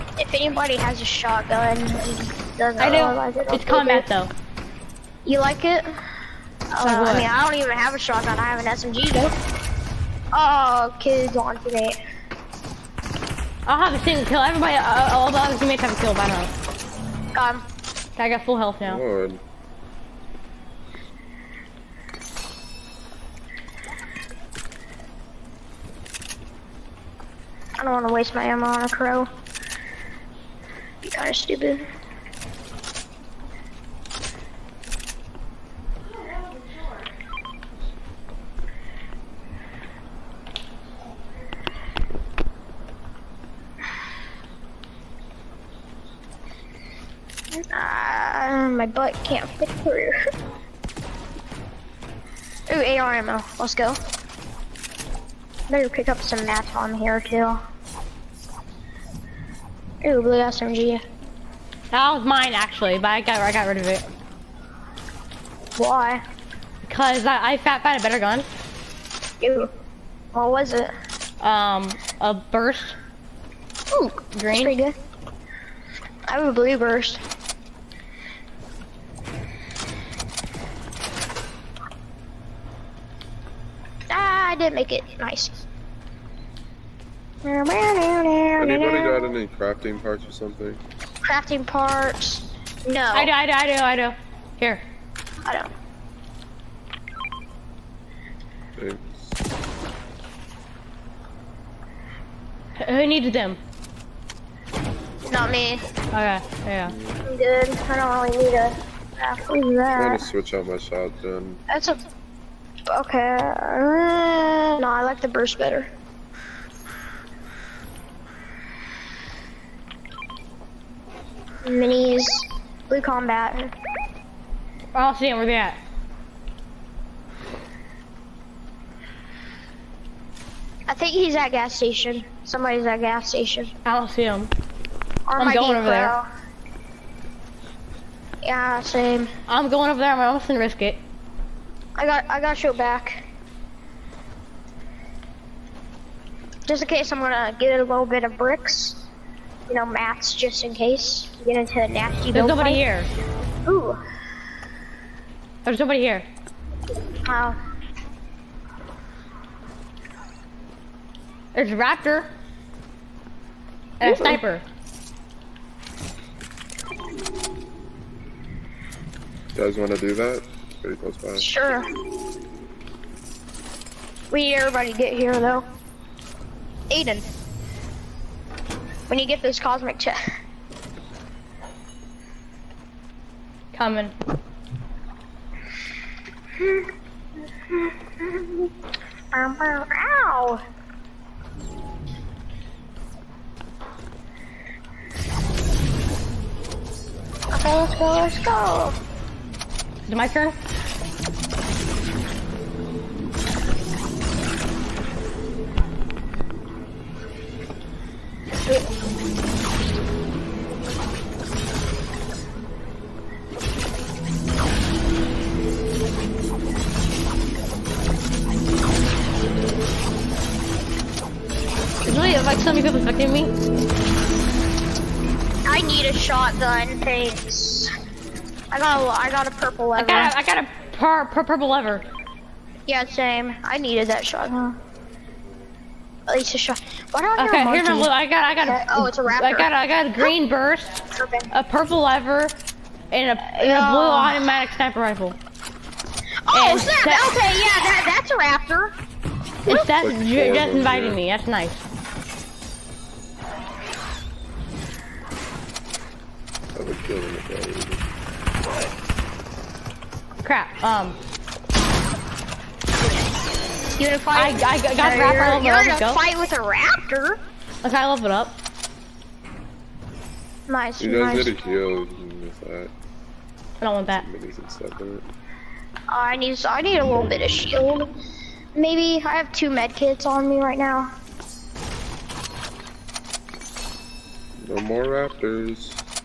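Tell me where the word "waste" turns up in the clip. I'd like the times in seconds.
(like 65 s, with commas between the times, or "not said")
28 s.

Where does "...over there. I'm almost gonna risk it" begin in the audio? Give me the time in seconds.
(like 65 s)
139 s.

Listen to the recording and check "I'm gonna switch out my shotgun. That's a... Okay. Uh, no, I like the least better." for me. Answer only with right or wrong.
wrong.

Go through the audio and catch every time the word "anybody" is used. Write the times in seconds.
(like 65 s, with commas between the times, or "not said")
0 s, 87 s.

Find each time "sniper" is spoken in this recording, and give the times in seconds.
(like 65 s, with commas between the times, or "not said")
164 s, 244 s.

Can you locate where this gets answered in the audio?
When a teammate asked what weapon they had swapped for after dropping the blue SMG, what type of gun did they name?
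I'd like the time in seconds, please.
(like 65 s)
72 s.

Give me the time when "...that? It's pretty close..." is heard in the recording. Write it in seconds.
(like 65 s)
170 s.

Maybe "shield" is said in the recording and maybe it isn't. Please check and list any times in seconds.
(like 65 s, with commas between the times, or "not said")
271 s, 277 s.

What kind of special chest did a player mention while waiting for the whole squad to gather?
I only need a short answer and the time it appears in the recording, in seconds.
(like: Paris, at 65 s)
Cosmic chest, at 179 s.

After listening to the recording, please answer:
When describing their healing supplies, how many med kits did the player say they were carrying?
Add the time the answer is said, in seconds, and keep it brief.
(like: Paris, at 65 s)
2, at 279 s.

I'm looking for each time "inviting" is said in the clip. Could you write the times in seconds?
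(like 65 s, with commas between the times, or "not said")
250 s.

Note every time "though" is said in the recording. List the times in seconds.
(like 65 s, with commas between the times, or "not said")
4 s, 9 s, 175 s.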